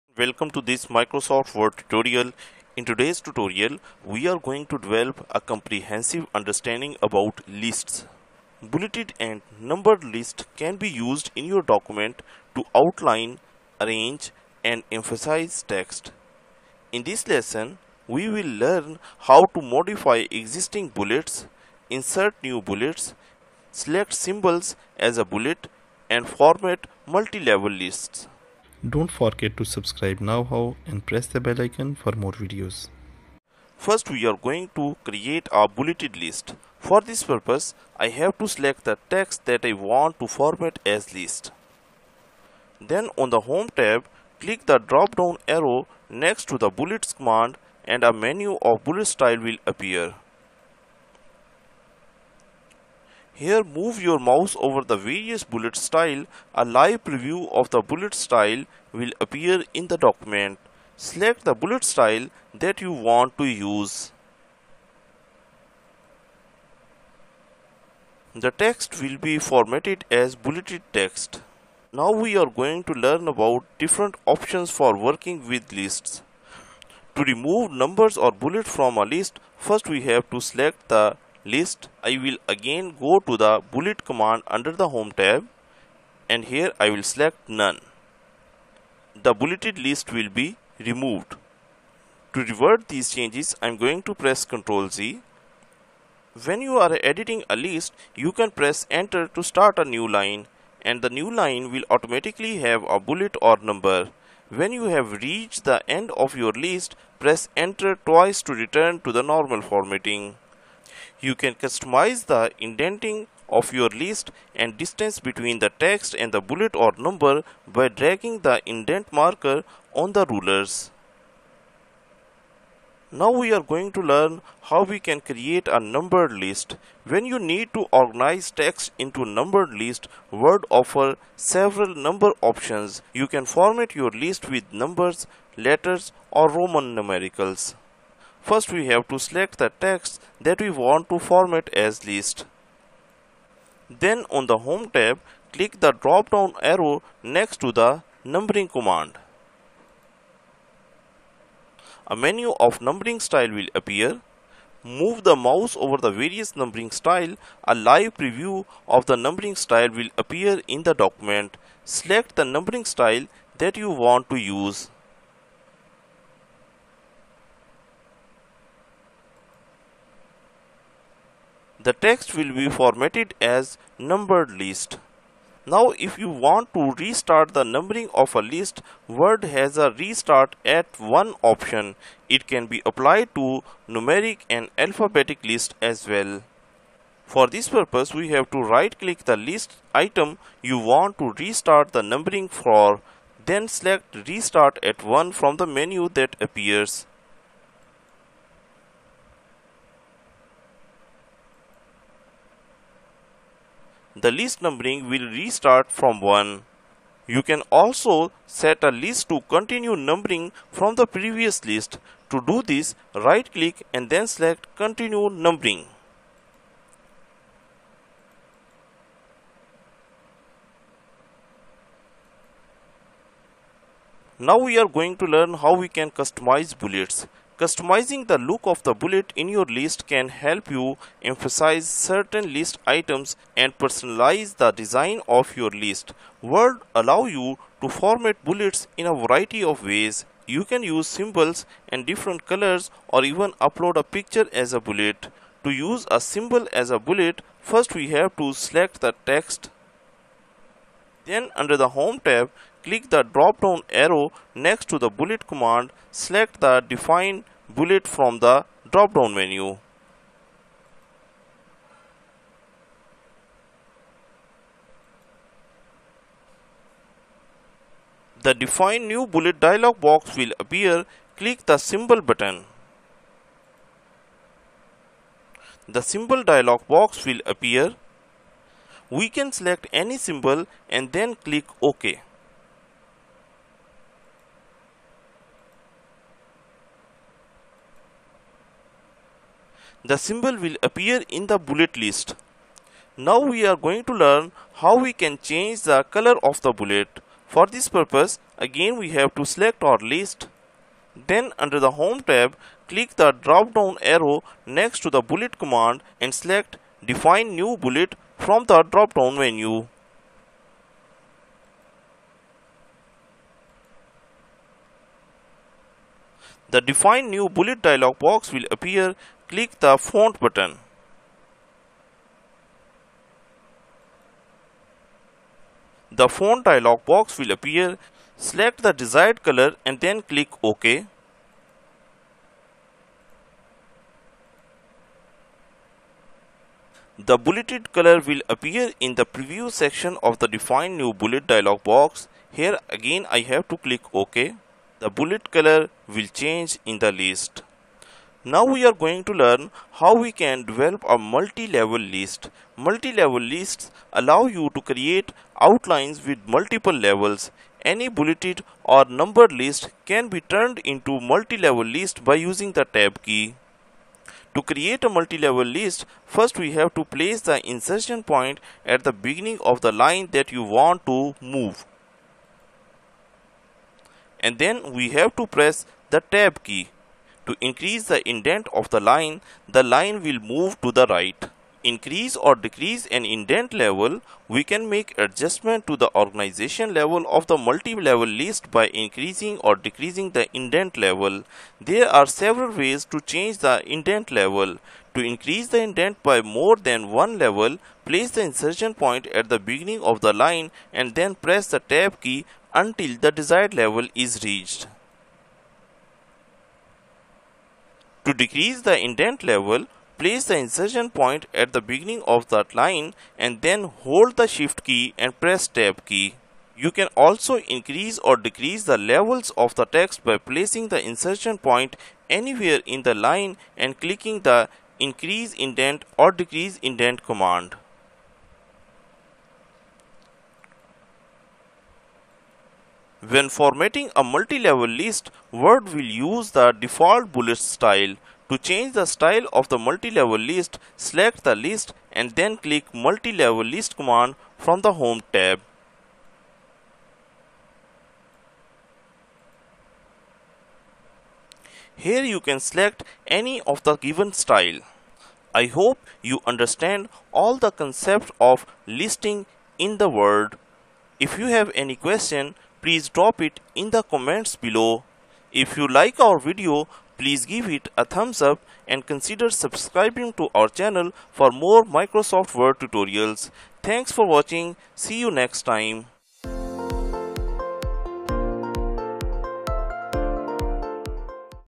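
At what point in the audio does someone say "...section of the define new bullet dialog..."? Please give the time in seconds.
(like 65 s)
339 s.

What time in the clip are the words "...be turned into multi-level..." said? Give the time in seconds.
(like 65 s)
360 s.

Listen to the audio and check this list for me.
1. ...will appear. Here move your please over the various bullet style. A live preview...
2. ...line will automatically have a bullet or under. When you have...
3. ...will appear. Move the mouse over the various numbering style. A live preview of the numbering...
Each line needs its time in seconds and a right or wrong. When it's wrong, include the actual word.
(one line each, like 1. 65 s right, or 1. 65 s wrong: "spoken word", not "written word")
1. 49 s wrong: "mouse", not "please"
2. 101 s wrong: "number", not "under"
3. 153 s right.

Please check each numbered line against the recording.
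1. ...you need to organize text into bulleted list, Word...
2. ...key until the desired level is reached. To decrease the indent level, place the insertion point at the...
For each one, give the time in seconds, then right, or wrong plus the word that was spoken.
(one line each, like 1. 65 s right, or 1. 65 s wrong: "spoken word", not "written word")
1. 127 s wrong: "numbered", not "bulleted"
2. 402 s right.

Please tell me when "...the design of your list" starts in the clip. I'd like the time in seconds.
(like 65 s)
234 s.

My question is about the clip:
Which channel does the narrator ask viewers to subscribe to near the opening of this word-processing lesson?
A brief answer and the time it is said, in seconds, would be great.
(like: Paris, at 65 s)
KnowHow, at 30 s.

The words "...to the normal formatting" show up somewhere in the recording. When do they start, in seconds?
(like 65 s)
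109 s.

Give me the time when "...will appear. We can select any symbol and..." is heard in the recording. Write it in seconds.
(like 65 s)
277 s.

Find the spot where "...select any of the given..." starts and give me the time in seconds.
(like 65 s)
452 s.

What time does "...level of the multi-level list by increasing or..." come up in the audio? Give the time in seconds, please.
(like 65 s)
386 s.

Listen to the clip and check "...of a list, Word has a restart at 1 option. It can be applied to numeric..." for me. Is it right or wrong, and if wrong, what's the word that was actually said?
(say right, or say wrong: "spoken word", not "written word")
right.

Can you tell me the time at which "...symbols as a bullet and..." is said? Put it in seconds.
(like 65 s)
24 s.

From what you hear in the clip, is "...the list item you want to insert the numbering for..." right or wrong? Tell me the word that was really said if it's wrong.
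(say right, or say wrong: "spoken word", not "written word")
wrong: "restart", not "insert".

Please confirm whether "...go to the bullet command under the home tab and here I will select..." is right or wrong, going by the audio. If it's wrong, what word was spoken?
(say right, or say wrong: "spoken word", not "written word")
right.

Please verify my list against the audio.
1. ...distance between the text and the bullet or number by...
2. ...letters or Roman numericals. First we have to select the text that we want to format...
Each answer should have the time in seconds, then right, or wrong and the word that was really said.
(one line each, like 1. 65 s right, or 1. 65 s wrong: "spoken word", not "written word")
1. 114 s right
2. 135 s right.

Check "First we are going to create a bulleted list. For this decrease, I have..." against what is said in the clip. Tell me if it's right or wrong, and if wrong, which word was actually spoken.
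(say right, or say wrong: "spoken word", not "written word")
wrong: "purpose", not "decrease".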